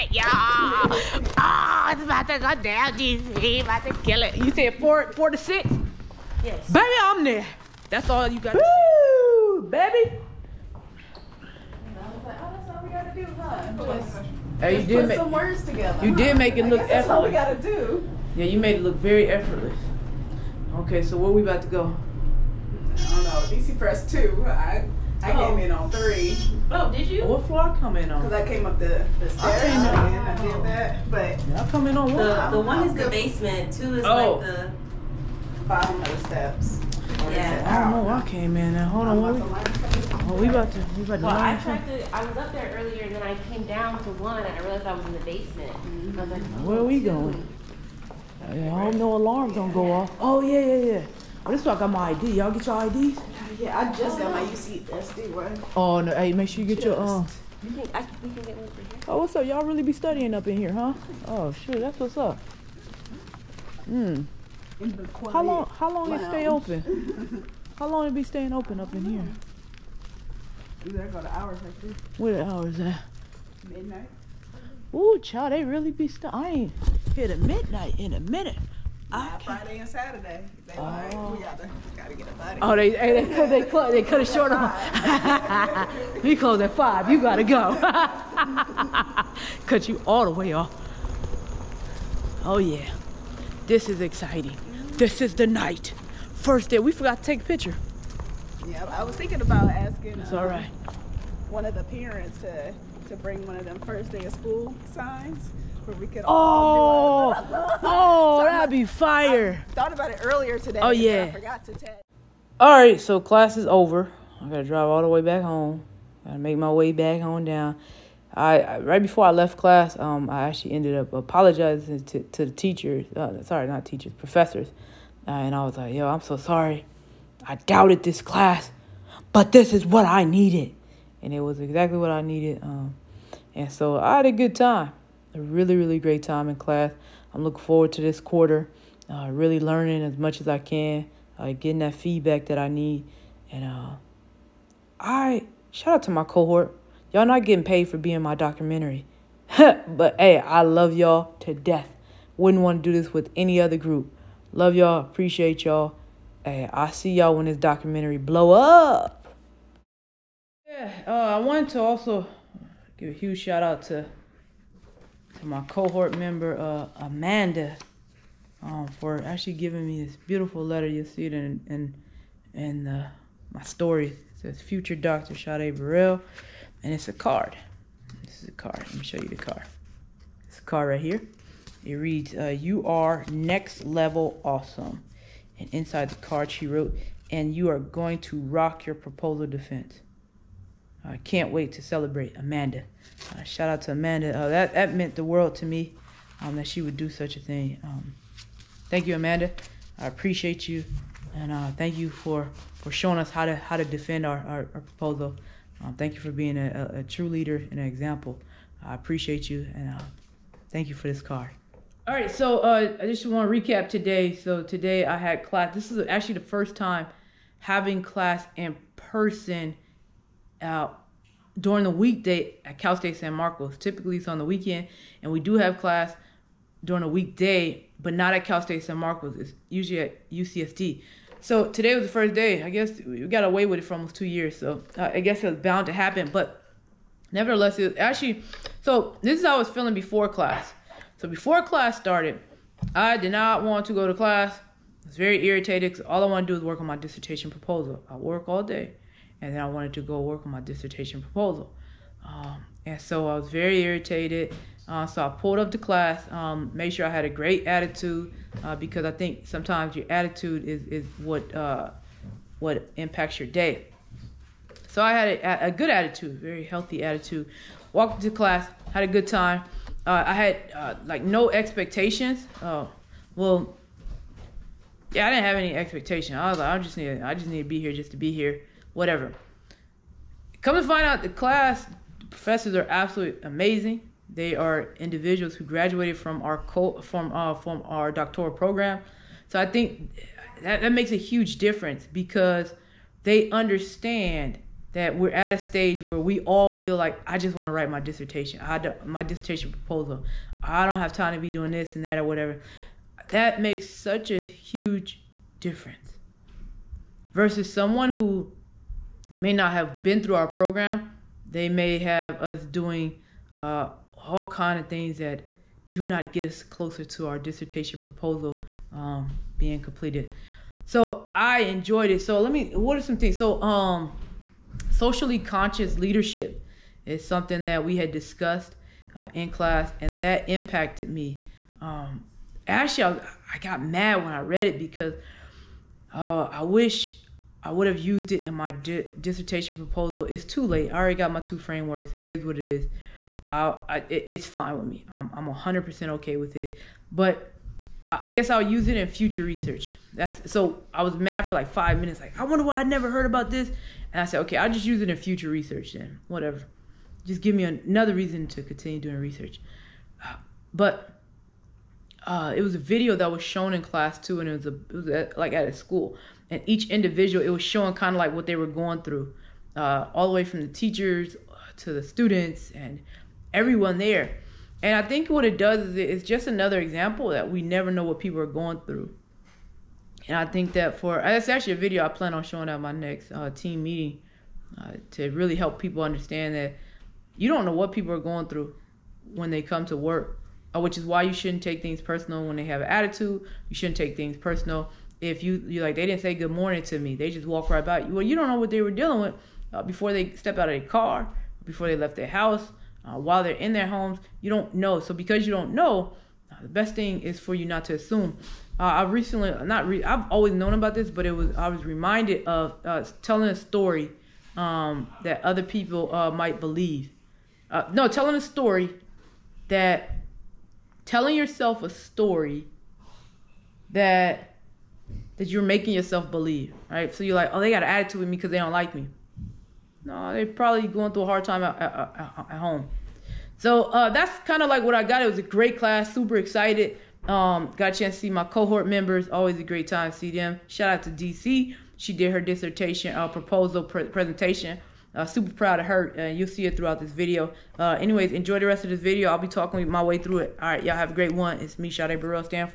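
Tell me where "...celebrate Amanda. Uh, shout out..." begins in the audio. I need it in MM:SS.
03:11.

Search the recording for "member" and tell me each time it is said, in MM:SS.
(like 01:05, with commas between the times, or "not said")
02:46, 07:18.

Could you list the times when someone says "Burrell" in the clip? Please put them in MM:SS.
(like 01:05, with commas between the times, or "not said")
02:55, 07:32.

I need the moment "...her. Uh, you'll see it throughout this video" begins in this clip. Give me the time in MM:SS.
07:25.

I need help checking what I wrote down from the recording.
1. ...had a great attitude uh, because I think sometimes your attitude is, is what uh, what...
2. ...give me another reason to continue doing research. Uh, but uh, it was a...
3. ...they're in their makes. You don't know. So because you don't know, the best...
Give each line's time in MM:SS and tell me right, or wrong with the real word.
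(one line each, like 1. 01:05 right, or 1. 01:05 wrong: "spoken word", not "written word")
1. 04:17 right
2. 05:57 right
3. 06:43 wrong: "homes", not "makes".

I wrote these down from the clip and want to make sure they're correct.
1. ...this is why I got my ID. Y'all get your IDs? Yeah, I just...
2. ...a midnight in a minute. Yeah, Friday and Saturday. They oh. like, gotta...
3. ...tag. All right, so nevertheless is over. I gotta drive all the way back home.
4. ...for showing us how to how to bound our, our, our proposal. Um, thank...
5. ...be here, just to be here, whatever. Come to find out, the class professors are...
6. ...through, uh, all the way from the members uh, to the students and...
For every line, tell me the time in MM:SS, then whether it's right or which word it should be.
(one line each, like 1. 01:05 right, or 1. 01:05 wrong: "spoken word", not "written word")
1. 00:51 right
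2. 01:17 right
3. 01:51 wrong: "class", not "nevertheless"
4. 03:22 wrong: "defend", not "bound"
5. 04:37 right
6. 06:09 wrong: "teachers", not "members".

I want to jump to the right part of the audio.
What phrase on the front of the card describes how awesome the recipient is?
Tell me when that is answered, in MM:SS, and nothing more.
03:03.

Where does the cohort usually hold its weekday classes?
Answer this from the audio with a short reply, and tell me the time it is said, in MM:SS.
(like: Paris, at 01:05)
UCSD, at 03:50.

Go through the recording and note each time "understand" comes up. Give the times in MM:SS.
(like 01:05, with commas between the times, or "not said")
04:53, 06:26.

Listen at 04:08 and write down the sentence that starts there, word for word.
I work all day, and then I wanted to go work on my dissertation proposal.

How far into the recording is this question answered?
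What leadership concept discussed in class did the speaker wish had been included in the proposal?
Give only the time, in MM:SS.
05:24.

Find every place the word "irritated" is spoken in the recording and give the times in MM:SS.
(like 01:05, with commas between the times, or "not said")
04:05, 04:13.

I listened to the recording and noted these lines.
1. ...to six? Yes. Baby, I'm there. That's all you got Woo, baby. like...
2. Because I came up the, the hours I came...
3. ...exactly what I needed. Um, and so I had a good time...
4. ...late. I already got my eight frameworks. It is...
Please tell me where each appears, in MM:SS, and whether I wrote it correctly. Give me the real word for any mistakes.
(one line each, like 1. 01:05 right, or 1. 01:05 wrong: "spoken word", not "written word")
1. 00:05 right
2. 00:28 wrong: "stairs", not "hours"
3. 02:11 right
4. 05:40 wrong: "two", not "eight".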